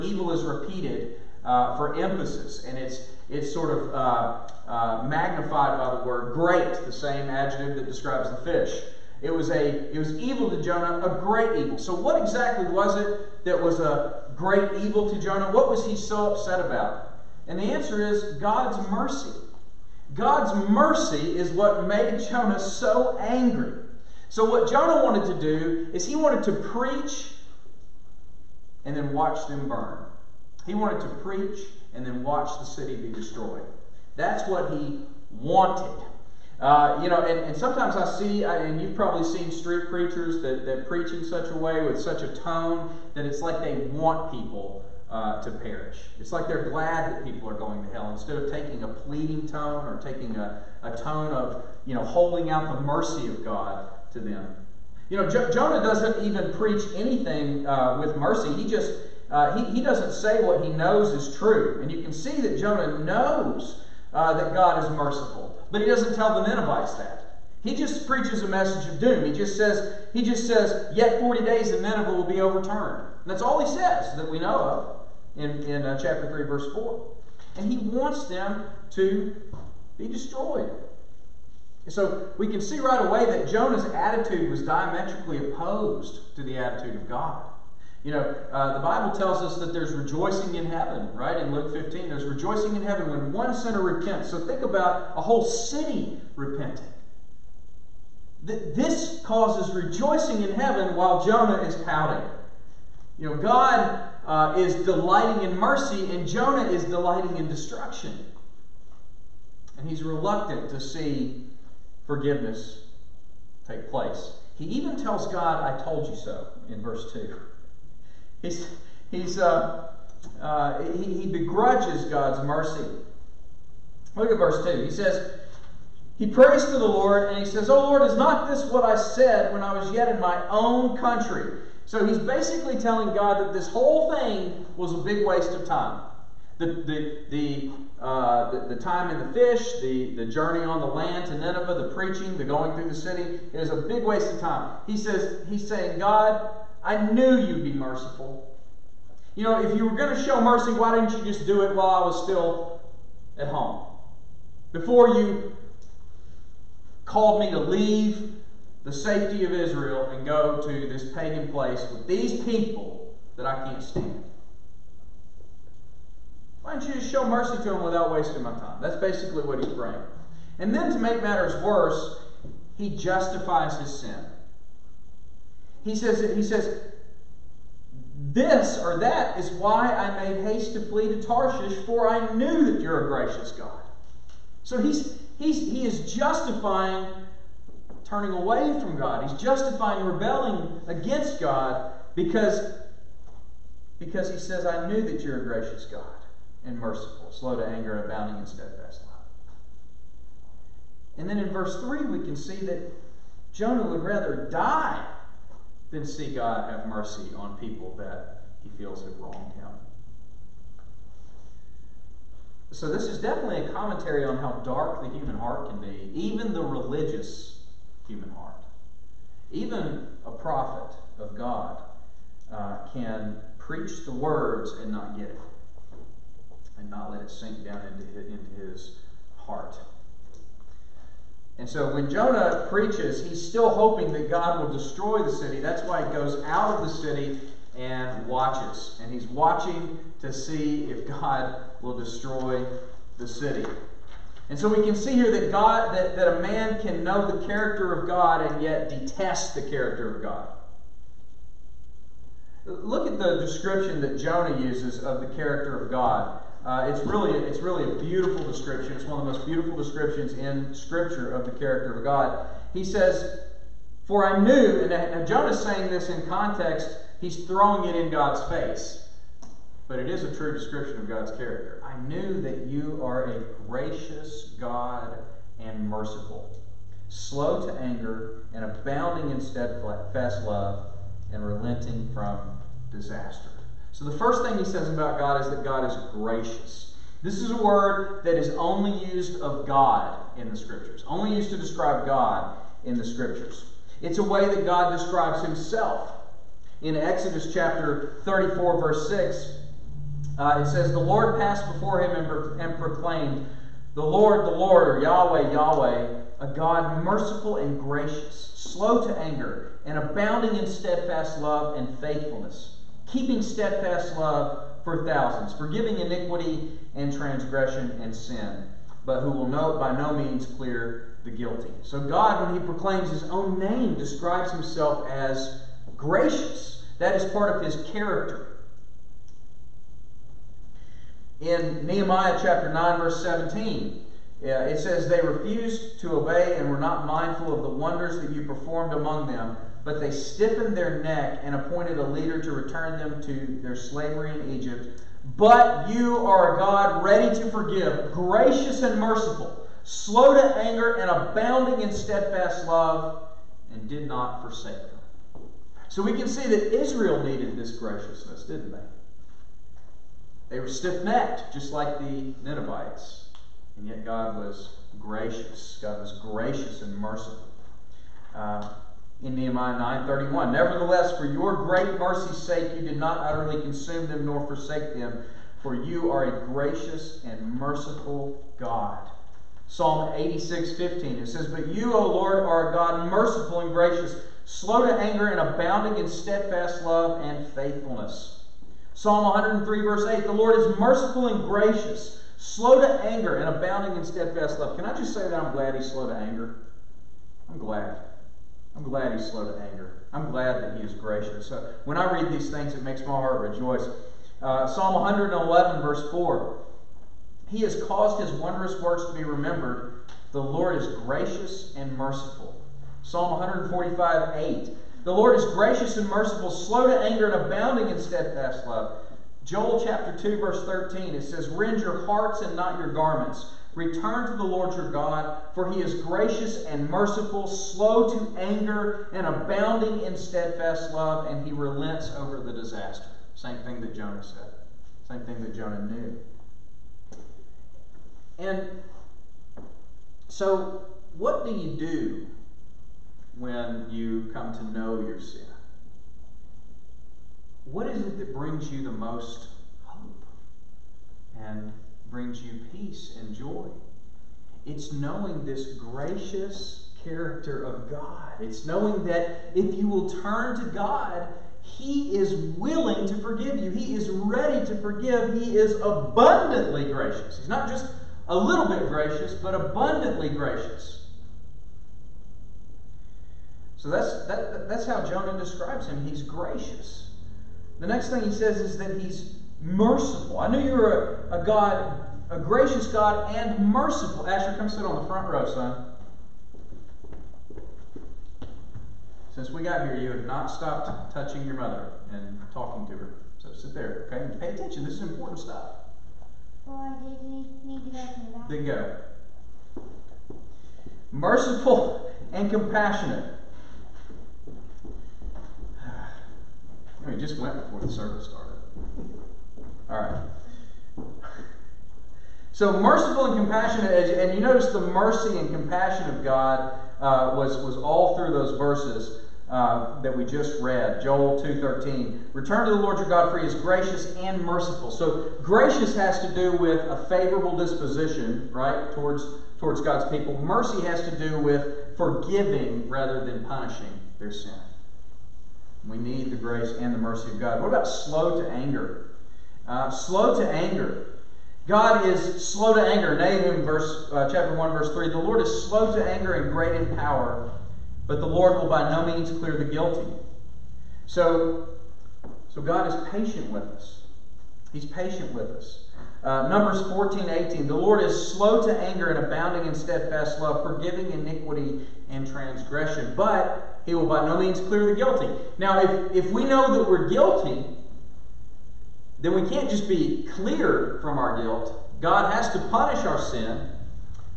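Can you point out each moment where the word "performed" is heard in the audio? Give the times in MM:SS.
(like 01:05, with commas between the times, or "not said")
05:38.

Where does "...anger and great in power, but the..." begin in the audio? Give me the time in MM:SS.
09:06.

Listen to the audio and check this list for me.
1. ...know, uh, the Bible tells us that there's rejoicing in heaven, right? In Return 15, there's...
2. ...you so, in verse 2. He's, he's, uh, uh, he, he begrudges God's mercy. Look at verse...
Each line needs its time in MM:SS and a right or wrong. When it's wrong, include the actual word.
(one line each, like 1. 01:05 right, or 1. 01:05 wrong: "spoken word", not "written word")
1. 01:28 wrong: "Luke", not "Return"
2. 01:56 right.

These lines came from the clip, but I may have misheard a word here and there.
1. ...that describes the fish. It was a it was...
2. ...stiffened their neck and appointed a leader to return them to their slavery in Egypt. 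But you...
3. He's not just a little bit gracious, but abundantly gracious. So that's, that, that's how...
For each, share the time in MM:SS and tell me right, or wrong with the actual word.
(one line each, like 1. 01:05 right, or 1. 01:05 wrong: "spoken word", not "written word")
1. 00:07 right
2. 05:40 right
3. 07:47 right.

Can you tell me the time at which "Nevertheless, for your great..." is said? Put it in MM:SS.
06:10.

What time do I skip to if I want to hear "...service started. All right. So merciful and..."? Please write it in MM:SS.
08:27.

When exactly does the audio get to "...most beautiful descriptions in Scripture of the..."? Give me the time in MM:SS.
04:19.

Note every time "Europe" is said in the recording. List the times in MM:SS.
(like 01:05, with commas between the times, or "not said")
not said.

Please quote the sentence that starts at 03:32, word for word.
So, this is definitely a commentary on how dark the human heart can be, even the religious human heart.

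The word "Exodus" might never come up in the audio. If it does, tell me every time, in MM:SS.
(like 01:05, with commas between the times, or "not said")
04:56.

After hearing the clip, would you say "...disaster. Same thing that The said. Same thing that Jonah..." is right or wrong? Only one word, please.
wrong.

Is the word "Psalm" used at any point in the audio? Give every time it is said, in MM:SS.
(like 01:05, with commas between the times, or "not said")
06:19, 06:28, 06:44, 06:53.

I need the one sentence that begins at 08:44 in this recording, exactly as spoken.
So gracious has to do with a favorable disposition, right, towards towards God's people.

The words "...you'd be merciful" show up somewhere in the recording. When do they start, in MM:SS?
02:27.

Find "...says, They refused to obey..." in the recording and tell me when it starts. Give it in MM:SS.
05:34.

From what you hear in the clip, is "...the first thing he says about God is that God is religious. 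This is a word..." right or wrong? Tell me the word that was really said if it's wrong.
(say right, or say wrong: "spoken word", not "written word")
wrong: "gracious", not "religious".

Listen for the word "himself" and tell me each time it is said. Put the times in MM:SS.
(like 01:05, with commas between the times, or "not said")
04:55, 05:24.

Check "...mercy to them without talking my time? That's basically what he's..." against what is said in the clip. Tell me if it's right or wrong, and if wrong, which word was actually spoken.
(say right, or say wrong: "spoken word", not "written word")
wrong: "wasting", not "talking".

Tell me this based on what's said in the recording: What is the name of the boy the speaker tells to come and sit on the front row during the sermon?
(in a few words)
Asher.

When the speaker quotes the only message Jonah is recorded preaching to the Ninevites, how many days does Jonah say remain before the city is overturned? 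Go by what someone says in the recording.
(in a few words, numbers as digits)
40.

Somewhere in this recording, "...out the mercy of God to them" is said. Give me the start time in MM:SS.
00:52.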